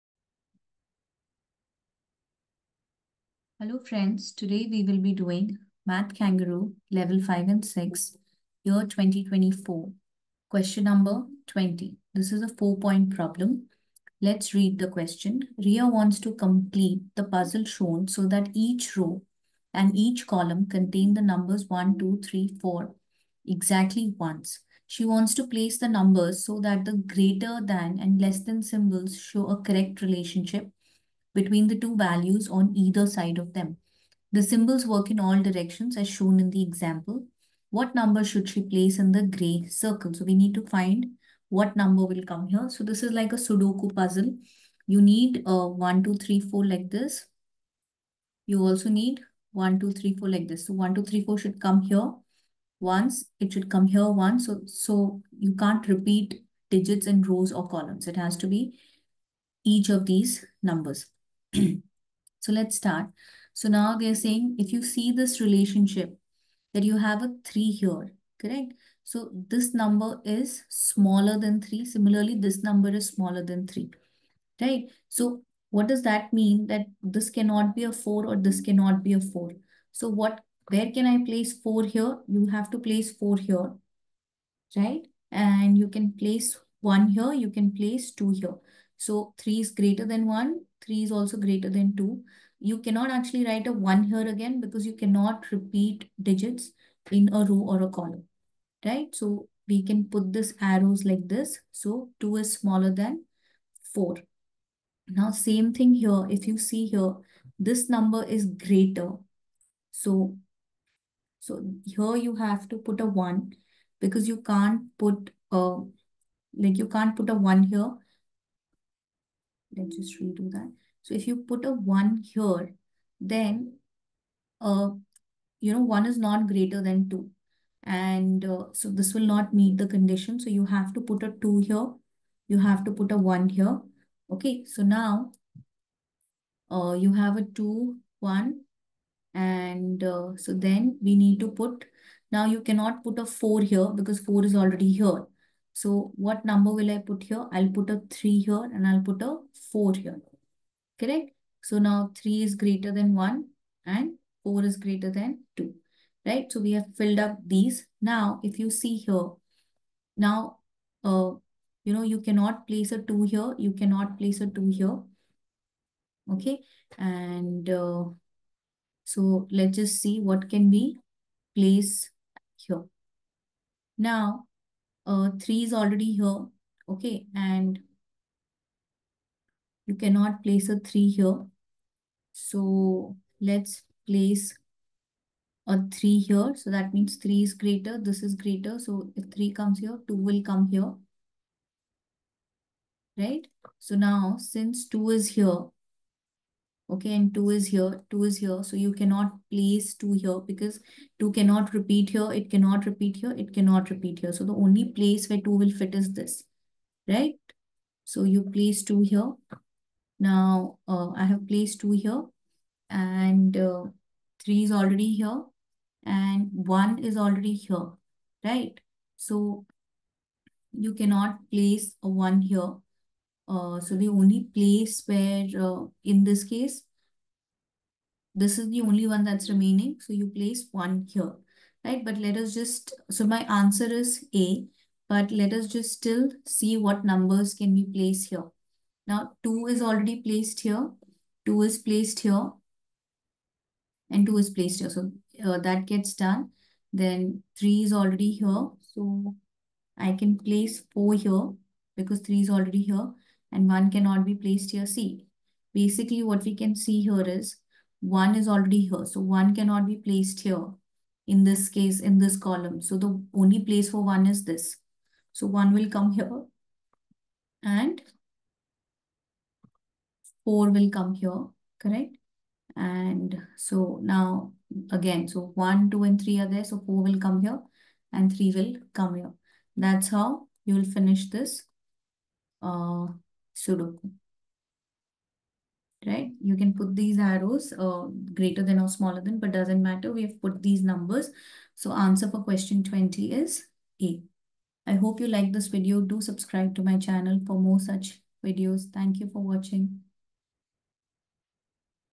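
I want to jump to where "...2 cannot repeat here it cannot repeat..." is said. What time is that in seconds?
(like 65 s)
201 s.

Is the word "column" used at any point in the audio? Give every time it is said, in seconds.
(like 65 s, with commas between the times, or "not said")
20 s, 57 s, 97 s, 262 s.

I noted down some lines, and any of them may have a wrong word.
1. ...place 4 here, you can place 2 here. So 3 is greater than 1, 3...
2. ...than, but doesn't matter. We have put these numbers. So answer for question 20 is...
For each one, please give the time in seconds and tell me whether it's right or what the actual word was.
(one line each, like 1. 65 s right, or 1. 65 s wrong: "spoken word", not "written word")
1. 86 s wrong: "1", not "4"
2. 289 s right.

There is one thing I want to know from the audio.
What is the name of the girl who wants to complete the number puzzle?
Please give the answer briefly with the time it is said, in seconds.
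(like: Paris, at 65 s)
Ria, at 15 s.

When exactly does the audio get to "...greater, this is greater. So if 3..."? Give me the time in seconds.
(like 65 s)
187 s.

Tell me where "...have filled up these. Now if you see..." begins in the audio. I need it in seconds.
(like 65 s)
156 s.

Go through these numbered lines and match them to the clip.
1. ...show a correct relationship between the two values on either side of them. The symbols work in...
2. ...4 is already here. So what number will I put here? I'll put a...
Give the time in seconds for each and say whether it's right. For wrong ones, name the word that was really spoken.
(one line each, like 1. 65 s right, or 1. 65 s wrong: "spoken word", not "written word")
1. 29 s right
2. 144 s right.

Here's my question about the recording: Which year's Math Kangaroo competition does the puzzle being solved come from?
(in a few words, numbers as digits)
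2024.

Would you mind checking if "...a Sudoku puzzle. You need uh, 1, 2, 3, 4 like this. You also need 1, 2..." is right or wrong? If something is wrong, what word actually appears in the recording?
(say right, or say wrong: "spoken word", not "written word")
right.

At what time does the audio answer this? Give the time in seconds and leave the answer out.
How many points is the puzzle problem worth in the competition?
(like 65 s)
12 s.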